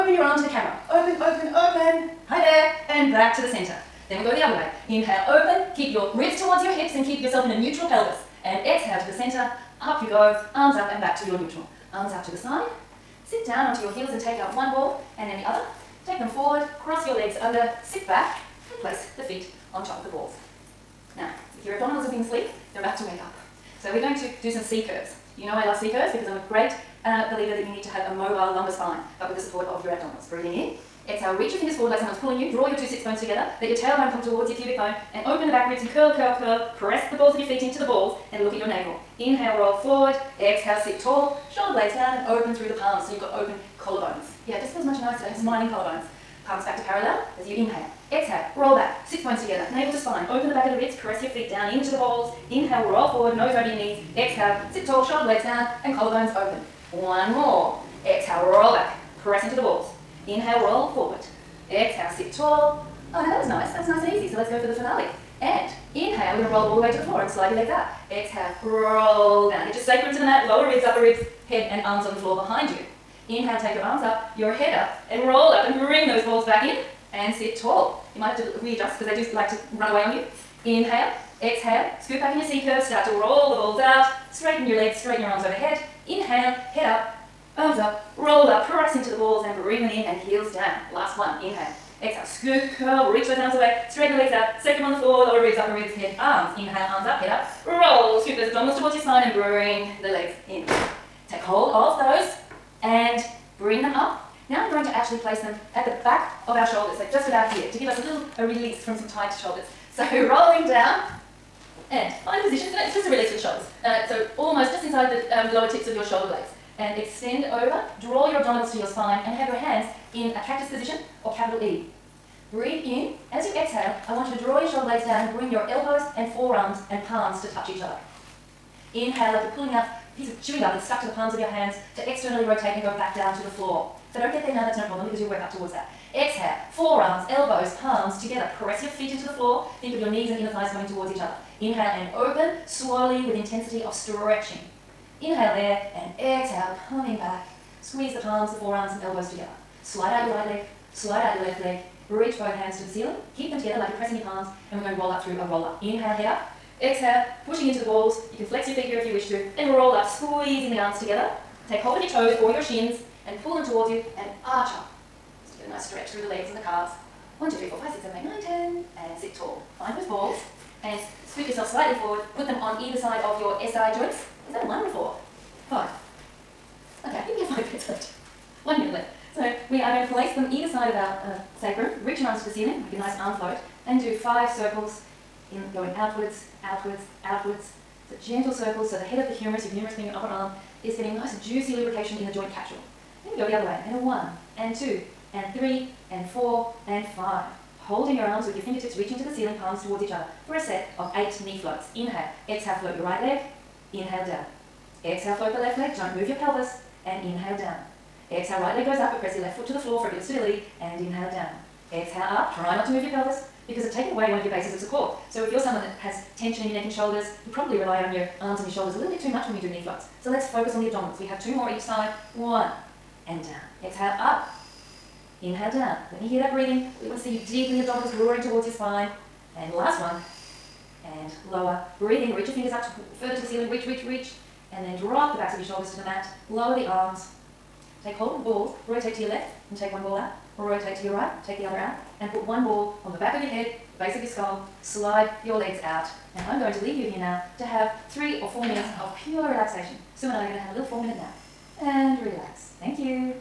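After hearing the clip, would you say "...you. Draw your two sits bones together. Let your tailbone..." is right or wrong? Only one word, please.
right.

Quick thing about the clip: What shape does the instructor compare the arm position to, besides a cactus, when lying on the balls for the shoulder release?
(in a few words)
capital E.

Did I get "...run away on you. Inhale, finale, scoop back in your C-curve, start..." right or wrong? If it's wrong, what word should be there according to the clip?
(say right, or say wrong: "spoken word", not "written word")
wrong: "exhale", not "finale".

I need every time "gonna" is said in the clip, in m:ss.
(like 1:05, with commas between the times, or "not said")
1:52.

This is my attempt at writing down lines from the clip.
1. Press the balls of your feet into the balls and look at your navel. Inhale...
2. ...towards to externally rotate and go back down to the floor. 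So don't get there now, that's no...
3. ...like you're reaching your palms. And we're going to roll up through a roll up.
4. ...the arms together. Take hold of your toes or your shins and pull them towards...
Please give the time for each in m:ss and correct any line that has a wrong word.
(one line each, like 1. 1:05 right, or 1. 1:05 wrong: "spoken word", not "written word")
1. 0:36 right
2. 2:11 wrong: "hands", not "towards"
3. 2:33 wrong: "pressing", not "reaching"
4. 2:40 right.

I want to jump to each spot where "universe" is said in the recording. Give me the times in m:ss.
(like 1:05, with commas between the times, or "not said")
not said.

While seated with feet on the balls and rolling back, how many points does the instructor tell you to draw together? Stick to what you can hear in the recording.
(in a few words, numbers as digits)
6.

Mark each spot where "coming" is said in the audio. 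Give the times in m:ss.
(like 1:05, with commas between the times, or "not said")
2:20, 2:26.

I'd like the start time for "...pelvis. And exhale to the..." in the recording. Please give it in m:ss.
0:07.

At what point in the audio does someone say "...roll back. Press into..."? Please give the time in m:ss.
0:58.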